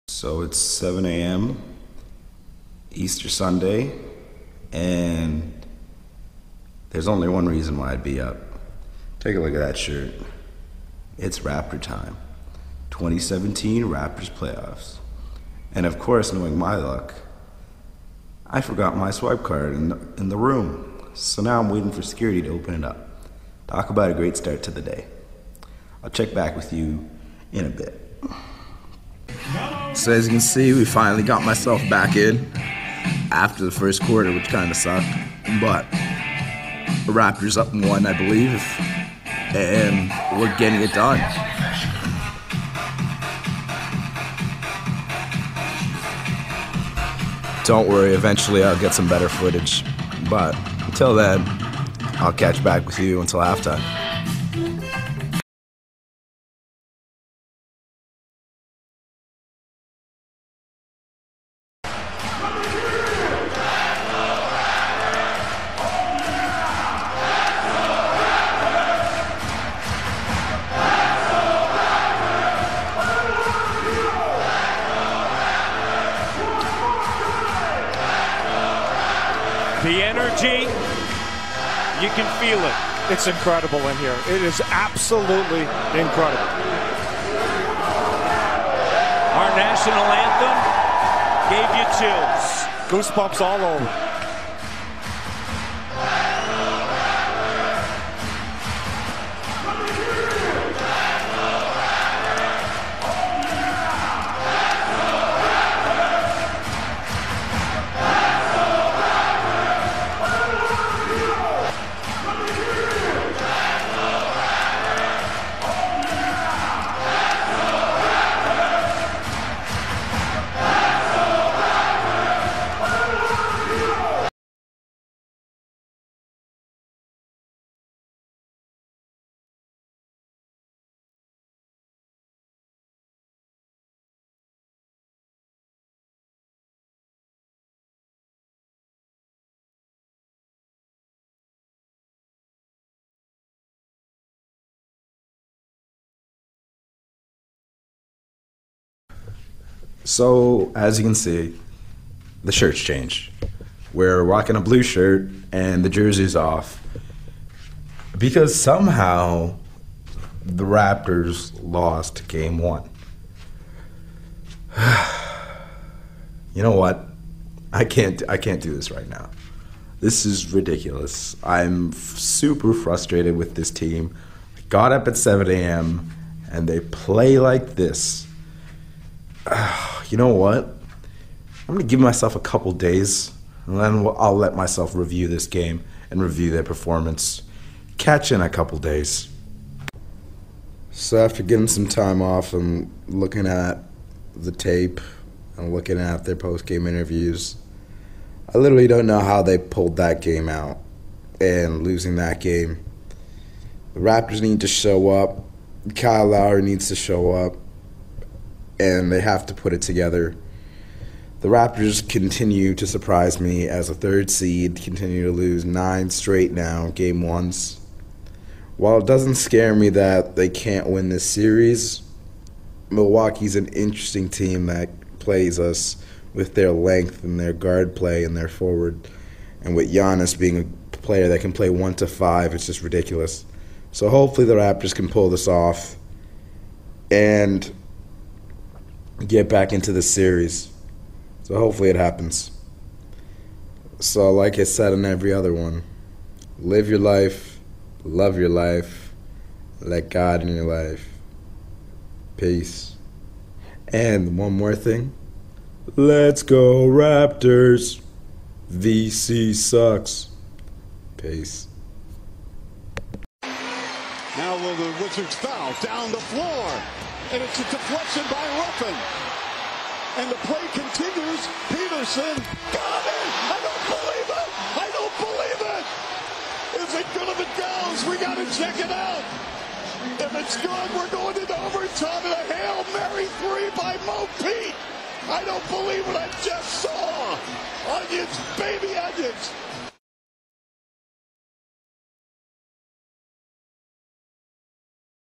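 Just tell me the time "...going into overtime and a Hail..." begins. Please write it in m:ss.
4:41.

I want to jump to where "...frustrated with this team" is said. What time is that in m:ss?
2:52.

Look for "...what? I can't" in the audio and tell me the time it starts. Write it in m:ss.
2:46.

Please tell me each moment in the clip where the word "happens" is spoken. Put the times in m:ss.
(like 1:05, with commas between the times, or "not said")
4:01.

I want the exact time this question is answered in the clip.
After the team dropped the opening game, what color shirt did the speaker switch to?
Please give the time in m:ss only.
2:34.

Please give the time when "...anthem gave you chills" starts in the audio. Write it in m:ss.
1:31.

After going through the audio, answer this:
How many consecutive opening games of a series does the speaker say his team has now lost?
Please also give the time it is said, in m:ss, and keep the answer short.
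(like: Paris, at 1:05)
9, at 3:35.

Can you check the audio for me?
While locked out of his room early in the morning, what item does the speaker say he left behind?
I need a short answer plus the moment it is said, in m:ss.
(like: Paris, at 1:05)
swipe card, at 0:19.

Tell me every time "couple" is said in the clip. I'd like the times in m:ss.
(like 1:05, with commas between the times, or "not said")
3:02, 3:08.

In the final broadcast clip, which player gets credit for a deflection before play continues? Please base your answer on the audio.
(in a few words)
Ruffin.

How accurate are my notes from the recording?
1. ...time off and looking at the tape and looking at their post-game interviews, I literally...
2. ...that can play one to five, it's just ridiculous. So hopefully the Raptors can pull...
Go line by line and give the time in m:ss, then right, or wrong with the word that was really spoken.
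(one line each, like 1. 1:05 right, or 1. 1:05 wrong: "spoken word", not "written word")
1. 3:11 right
2. 3:51 right.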